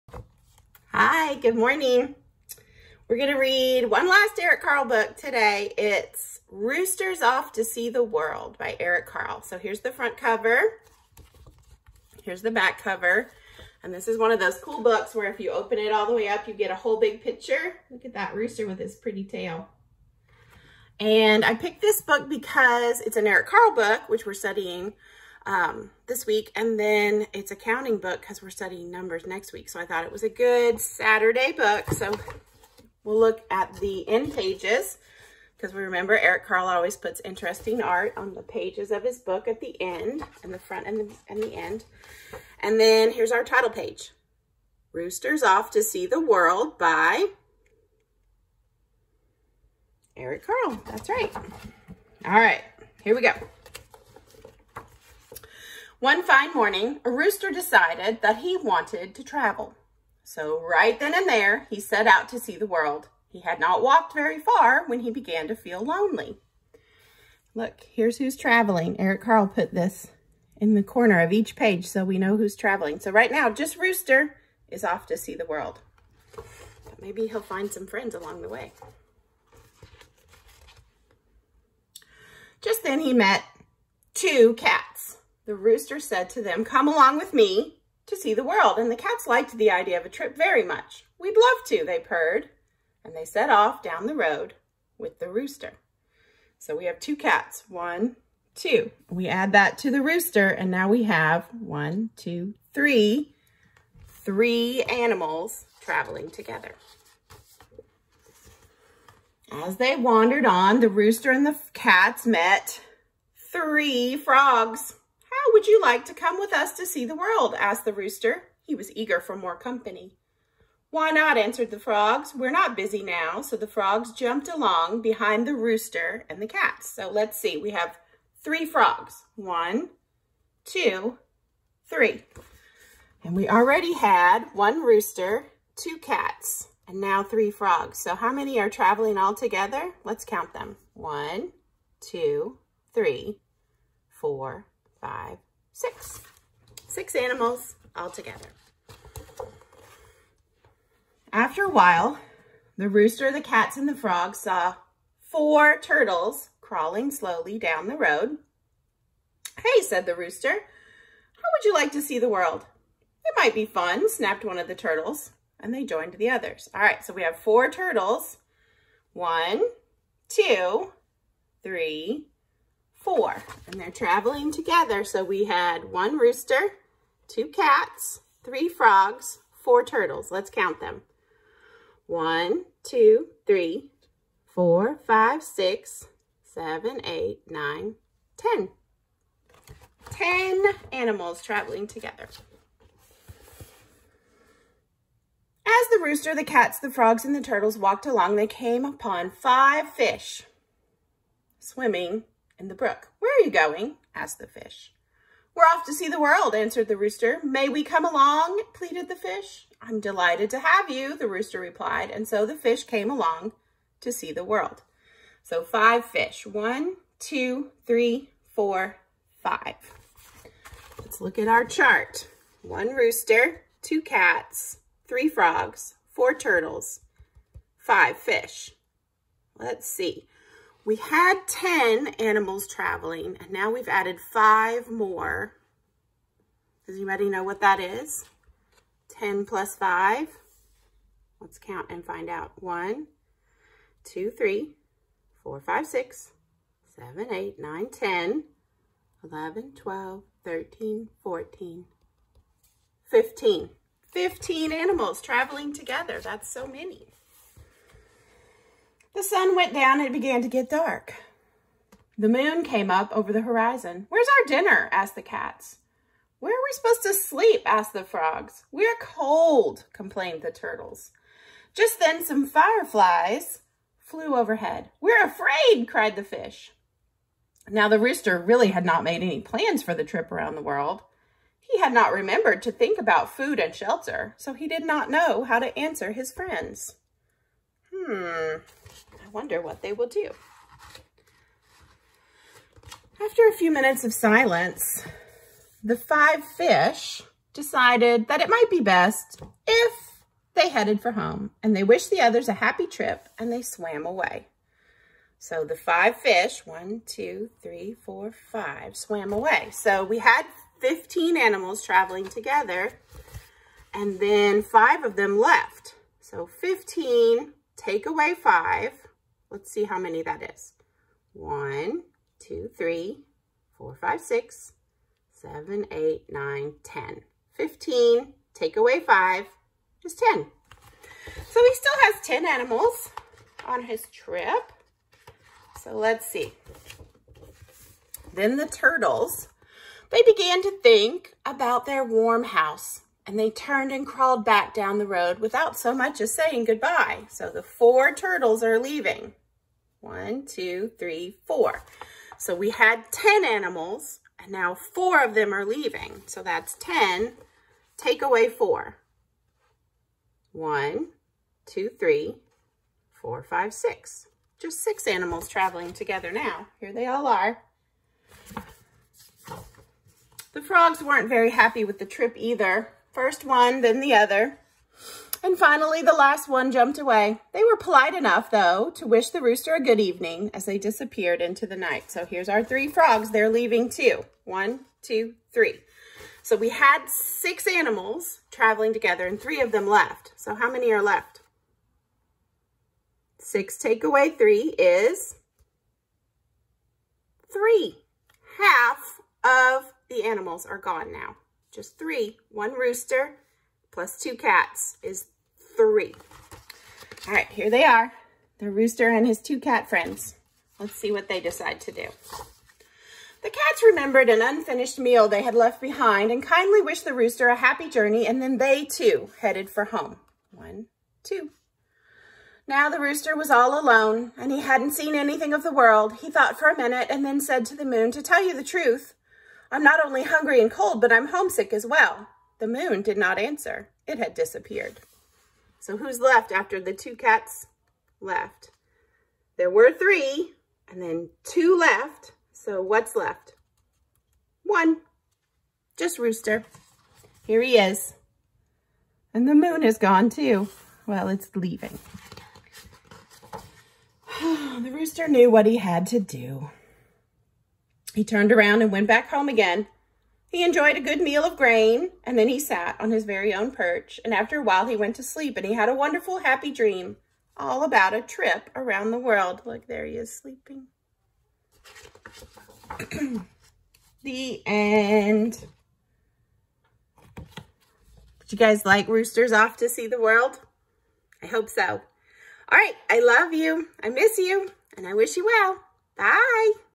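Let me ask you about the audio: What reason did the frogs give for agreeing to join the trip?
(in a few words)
We're not busy now.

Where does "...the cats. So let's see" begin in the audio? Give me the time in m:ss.
2:06.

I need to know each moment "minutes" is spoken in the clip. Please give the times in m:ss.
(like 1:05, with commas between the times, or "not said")
4:53, 7:06.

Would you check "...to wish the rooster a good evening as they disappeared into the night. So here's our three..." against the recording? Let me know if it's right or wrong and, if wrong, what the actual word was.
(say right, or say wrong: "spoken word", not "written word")
right.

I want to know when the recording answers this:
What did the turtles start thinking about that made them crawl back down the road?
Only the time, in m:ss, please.
5:41.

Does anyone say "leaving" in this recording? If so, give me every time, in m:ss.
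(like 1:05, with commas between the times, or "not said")
5:48, 5:55, 6:23, 7:31.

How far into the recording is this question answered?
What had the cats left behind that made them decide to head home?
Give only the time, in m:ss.
6:54.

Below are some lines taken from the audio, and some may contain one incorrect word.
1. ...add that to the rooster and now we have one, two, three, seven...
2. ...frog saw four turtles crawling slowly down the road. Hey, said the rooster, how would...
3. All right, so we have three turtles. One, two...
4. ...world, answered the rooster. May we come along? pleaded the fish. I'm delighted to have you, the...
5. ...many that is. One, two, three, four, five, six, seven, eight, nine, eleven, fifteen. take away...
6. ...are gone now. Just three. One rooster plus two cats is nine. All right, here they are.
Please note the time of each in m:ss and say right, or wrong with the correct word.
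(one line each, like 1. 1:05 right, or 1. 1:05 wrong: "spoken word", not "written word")
1. 1:39 wrong: "three", not "seven"
2. 2:33 right
3. 2:46 wrong: "four", not "three"
4. 3:26 right
5. 5:19 wrong: "ten", not "eleven"
6. 6:40 wrong: "three", not "nine".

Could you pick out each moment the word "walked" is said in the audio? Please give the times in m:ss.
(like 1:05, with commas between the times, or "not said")
1:03, 3:17.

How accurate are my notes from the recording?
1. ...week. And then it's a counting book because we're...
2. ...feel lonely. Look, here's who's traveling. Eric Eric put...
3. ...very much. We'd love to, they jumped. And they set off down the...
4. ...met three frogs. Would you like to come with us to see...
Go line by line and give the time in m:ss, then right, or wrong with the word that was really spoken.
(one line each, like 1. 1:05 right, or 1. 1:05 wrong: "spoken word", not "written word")
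1. 0:26 right
2. 1:05 wrong: "Carle", not "Eric"
3. 1:30 wrong: "purred", not "jumped"
4. 1:52 right.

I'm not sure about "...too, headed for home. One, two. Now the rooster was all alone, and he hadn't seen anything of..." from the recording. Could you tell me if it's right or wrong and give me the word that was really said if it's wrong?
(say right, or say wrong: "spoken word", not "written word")
right.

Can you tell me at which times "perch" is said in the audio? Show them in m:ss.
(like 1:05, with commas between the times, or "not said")
7:43.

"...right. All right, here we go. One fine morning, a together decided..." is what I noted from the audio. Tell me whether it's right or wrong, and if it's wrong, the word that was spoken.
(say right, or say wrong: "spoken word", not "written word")
wrong: "rooster", not "together".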